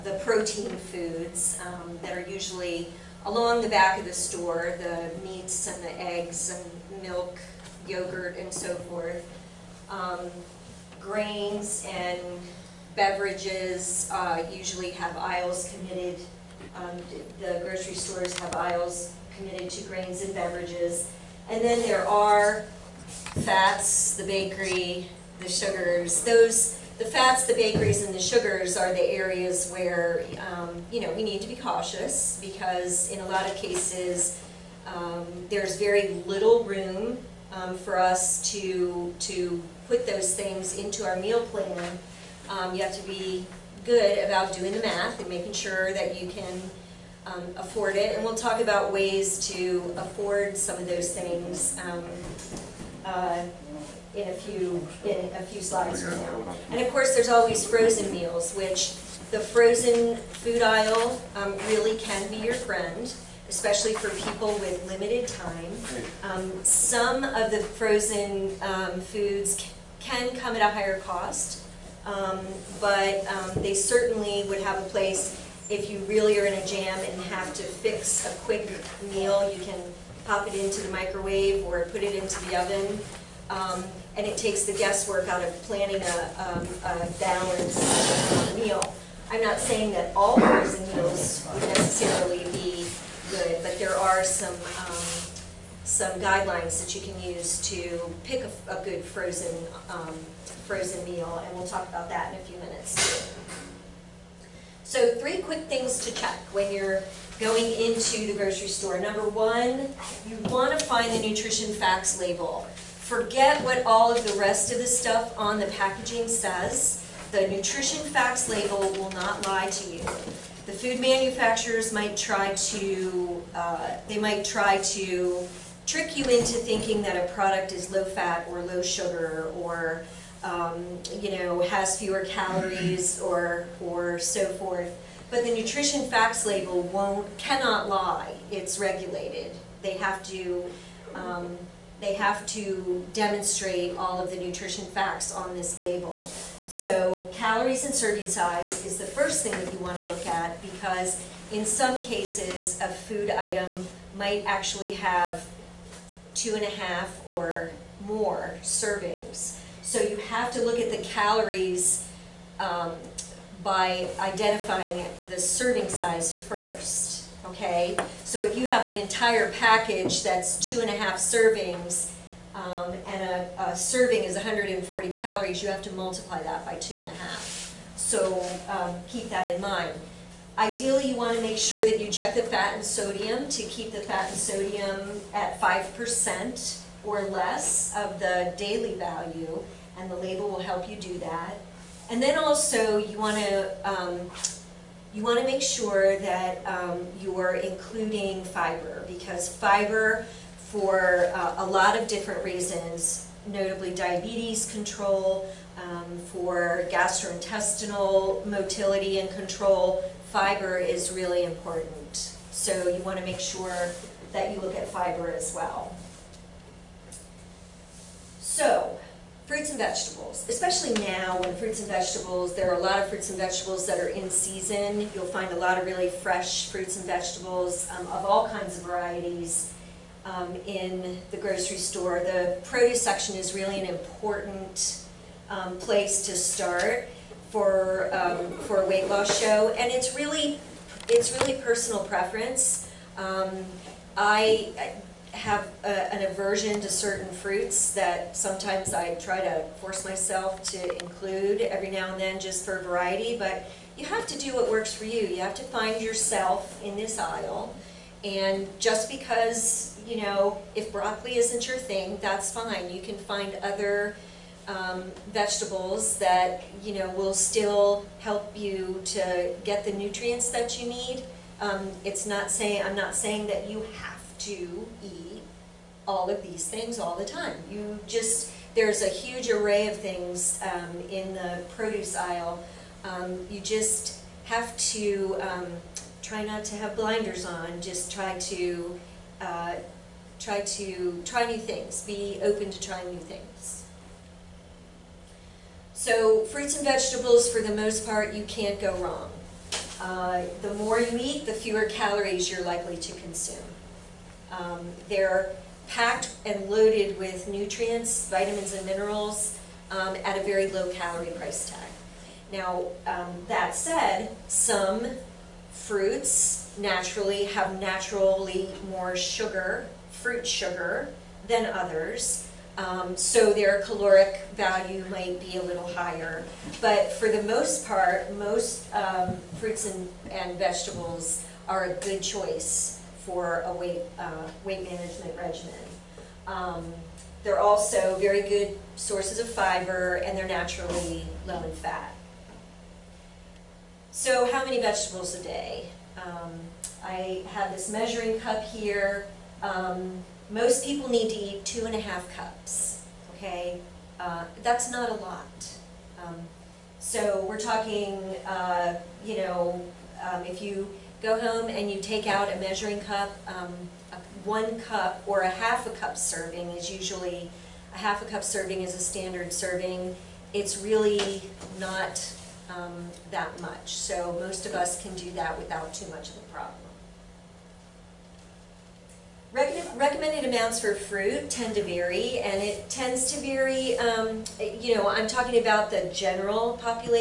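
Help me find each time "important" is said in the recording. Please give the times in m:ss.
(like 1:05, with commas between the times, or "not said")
3:31, 3:53.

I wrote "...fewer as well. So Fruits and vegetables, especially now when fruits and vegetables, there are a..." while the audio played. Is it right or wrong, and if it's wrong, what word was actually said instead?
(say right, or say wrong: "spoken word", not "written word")
wrong: "fiber", not "fewer".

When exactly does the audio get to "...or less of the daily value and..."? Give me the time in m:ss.
3:07.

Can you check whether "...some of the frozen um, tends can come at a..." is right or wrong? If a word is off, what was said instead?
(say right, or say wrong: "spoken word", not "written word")
wrong: "foods", not "tends".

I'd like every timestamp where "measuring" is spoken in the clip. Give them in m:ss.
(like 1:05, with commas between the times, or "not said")
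5:47, 6:02.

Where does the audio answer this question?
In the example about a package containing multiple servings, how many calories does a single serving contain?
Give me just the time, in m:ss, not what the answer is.
2:54.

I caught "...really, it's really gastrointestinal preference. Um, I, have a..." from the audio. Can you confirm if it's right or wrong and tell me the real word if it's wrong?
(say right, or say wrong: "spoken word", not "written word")
wrong: "personal", not "gastrointestinal".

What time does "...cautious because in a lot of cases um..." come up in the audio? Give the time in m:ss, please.
0:31.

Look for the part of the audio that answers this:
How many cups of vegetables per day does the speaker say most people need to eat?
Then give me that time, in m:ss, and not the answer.
5:51.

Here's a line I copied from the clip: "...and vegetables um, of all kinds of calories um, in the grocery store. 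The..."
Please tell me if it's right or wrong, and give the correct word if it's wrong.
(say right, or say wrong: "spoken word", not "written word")
wrong: "varieties", not "calories".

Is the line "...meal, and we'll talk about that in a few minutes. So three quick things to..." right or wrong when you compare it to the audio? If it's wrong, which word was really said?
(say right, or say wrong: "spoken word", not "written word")
right.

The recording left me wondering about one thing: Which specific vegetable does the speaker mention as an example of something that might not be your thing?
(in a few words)
broccoli.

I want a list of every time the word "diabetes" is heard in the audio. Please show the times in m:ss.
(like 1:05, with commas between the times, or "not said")
3:23.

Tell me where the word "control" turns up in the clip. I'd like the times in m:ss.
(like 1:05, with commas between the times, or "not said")
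3:24, 3:29.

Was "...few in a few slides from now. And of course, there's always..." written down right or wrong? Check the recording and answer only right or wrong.
right.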